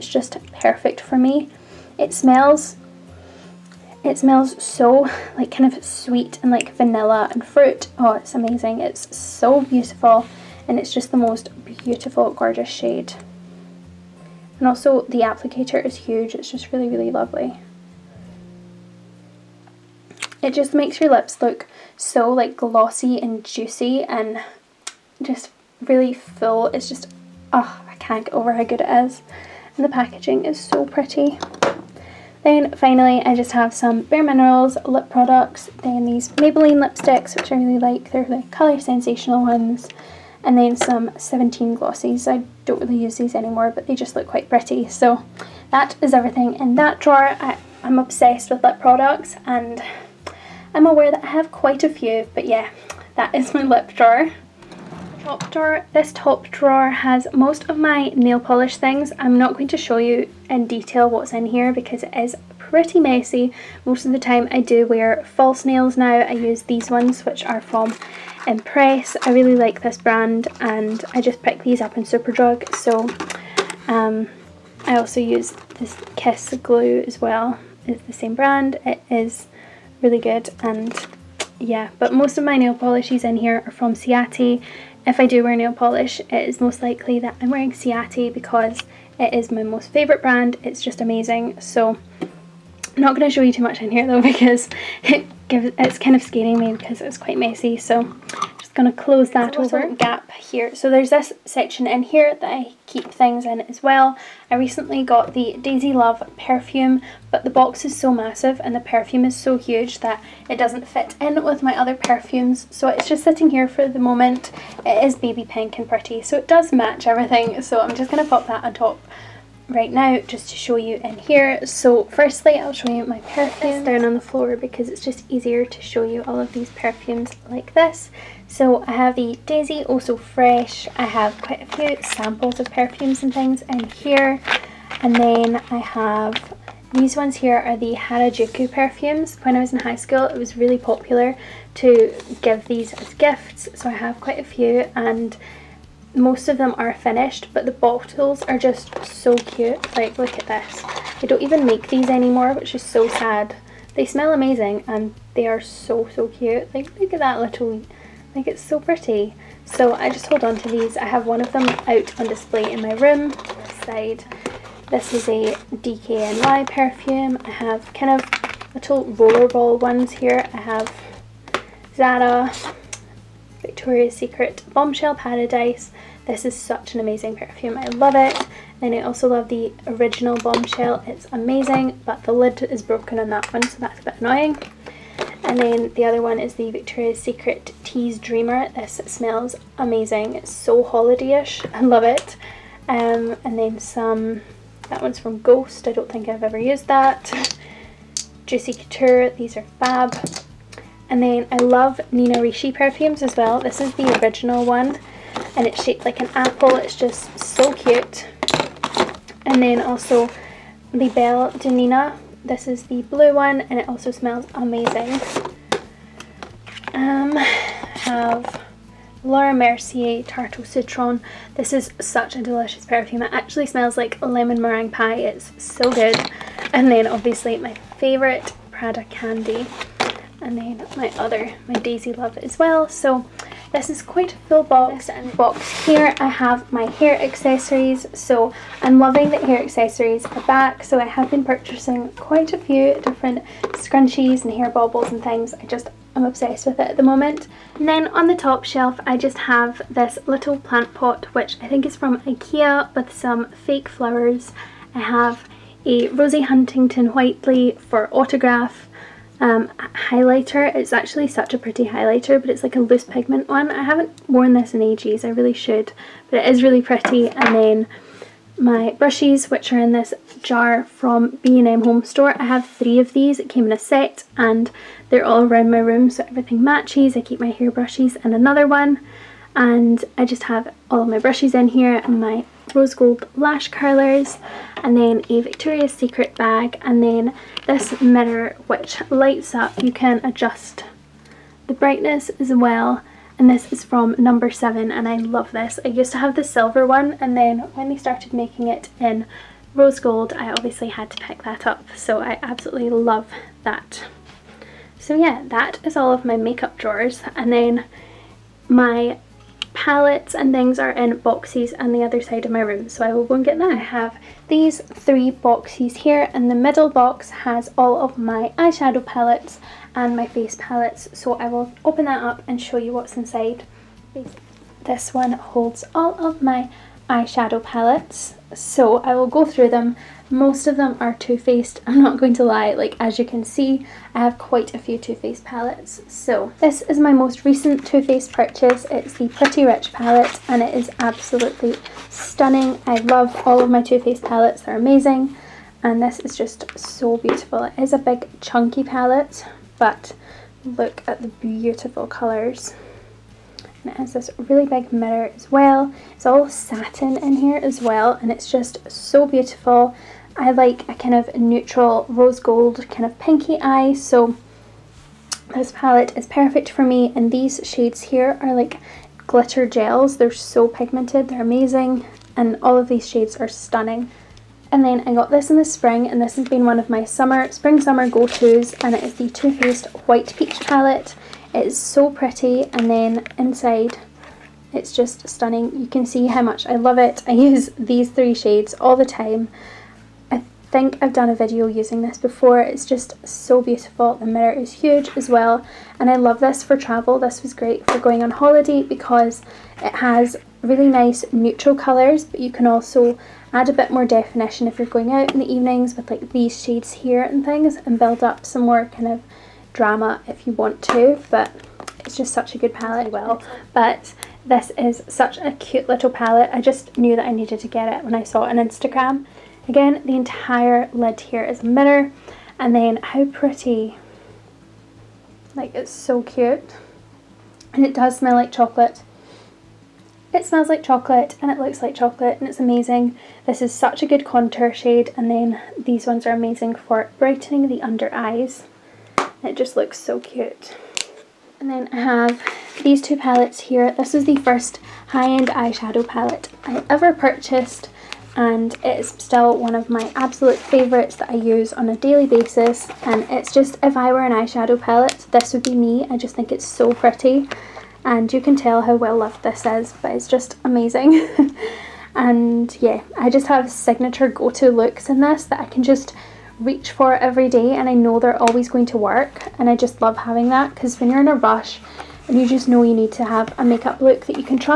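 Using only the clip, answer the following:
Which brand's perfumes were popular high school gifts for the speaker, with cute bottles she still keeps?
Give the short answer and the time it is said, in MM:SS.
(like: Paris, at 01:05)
Harajuku, at 02:17.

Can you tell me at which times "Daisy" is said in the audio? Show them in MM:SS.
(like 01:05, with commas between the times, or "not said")
01:45, 02:09, 03:51.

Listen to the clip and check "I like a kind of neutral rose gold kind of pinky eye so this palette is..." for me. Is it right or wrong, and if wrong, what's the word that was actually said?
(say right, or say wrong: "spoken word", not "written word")
right.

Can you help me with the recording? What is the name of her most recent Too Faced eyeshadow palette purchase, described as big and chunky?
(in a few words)
Pretty Rich.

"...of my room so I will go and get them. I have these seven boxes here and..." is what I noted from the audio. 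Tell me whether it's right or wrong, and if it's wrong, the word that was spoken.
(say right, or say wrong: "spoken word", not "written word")
wrong: "three", not "seven".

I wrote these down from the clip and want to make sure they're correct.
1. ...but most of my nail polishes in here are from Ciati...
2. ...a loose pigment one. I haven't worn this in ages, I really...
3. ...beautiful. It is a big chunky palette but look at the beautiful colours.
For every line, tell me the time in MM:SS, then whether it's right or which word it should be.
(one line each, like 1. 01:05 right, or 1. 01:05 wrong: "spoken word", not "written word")
1. 01:21 right
2. 04:22 right
3. 05:47 right.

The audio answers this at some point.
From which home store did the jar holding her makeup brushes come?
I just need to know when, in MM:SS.
04:31.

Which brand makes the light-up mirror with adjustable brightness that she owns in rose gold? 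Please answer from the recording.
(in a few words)
Number 7.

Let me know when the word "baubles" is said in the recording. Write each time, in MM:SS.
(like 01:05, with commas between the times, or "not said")
04:04.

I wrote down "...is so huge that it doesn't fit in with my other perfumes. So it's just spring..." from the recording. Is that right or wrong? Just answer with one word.
wrong.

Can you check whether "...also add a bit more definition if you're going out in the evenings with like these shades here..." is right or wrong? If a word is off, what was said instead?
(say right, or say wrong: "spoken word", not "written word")
right.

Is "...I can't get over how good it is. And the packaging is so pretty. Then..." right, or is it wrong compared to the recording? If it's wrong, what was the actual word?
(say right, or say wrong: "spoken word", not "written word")
right.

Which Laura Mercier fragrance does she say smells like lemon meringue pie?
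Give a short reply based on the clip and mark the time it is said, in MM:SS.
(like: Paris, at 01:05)
Tarte au Citron, at 03:40.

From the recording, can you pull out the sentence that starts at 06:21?
It is so pretty and then inside it's just stunning.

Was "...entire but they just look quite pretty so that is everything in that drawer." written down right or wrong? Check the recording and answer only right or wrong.
wrong.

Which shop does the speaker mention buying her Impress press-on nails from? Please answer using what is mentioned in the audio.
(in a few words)
Superdrug.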